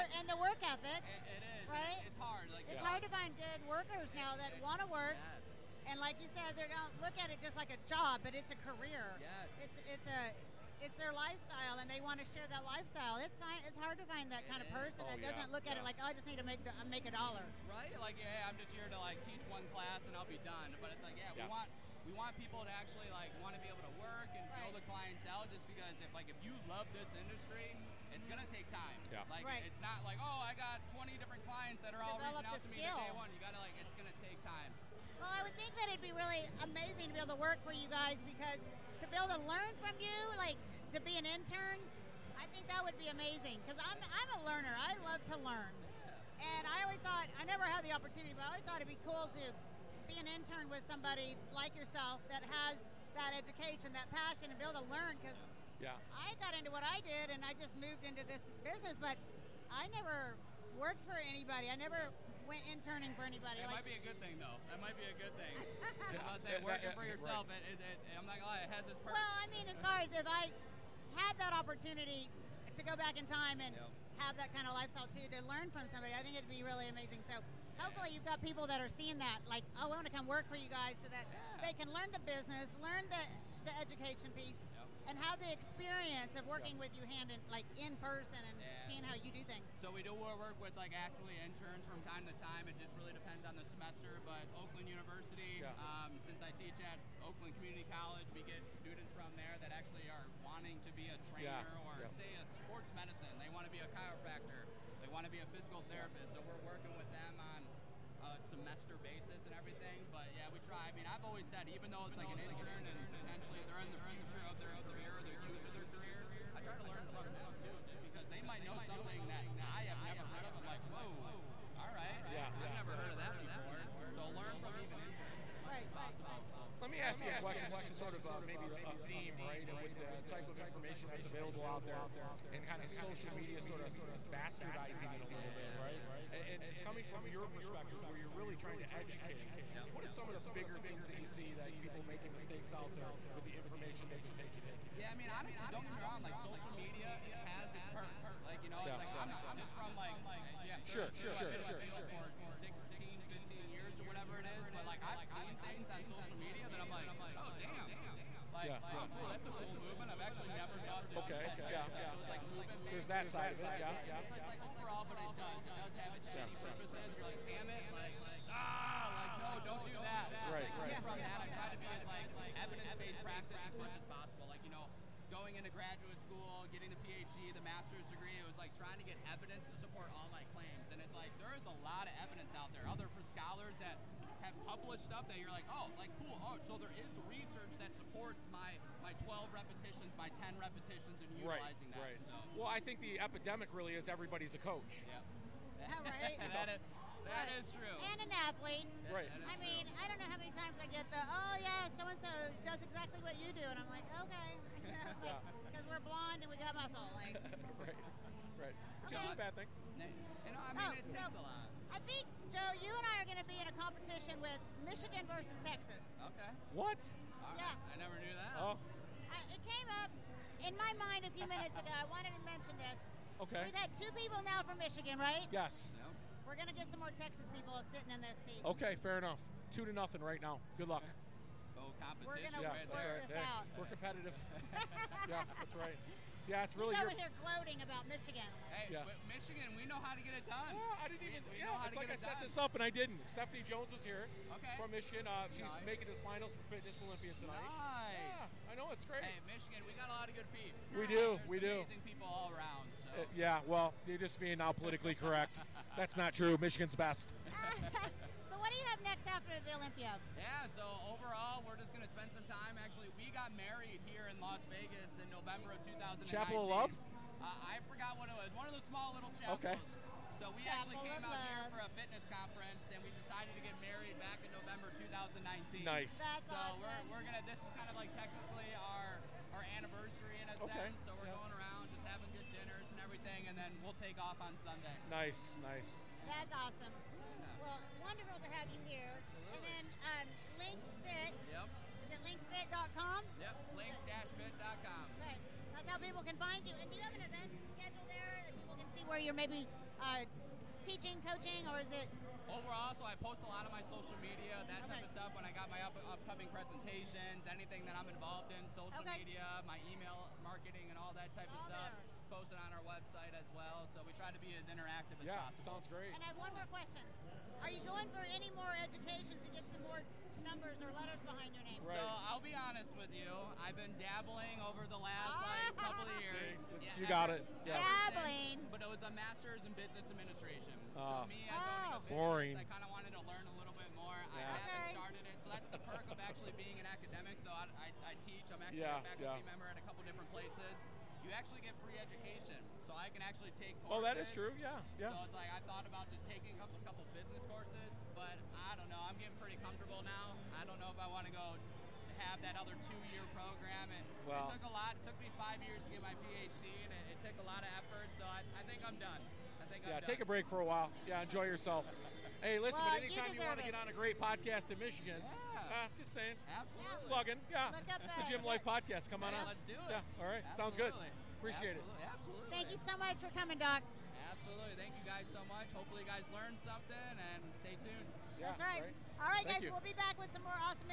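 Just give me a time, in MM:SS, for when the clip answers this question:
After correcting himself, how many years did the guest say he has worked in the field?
02:32.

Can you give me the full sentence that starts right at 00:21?
we want we want people to actually like want to be able to work and right.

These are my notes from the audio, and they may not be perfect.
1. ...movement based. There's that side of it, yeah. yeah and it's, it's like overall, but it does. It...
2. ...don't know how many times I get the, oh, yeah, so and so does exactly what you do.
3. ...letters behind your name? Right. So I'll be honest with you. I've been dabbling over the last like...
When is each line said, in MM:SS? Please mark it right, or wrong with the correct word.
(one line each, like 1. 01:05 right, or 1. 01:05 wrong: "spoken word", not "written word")
1. 02:42 right
2. 03:20 right
3. 05:20 right.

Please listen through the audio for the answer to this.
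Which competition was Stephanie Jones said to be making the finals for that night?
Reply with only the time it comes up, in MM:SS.
04:06.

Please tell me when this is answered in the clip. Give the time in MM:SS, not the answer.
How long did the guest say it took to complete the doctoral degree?
05:55.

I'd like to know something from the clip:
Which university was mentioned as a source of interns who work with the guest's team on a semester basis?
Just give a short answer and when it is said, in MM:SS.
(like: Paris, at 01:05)
Oakland University, at 01:34.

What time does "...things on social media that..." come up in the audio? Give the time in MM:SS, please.
02:35.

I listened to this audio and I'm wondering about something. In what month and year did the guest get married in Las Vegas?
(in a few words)
November 2019.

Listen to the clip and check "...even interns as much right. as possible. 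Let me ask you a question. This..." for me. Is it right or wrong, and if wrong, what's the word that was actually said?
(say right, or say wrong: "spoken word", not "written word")
right.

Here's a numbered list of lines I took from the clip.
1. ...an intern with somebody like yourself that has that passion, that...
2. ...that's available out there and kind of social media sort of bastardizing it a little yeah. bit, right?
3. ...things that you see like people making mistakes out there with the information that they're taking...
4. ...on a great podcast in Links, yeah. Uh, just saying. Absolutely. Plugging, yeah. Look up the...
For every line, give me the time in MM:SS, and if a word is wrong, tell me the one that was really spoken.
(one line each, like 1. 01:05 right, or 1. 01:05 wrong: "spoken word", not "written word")
1. 00:50 wrong: "education", not "passion"
2. 02:11 right
3. 02:20 right
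4. 06:03 wrong: "Michigan", not "Links".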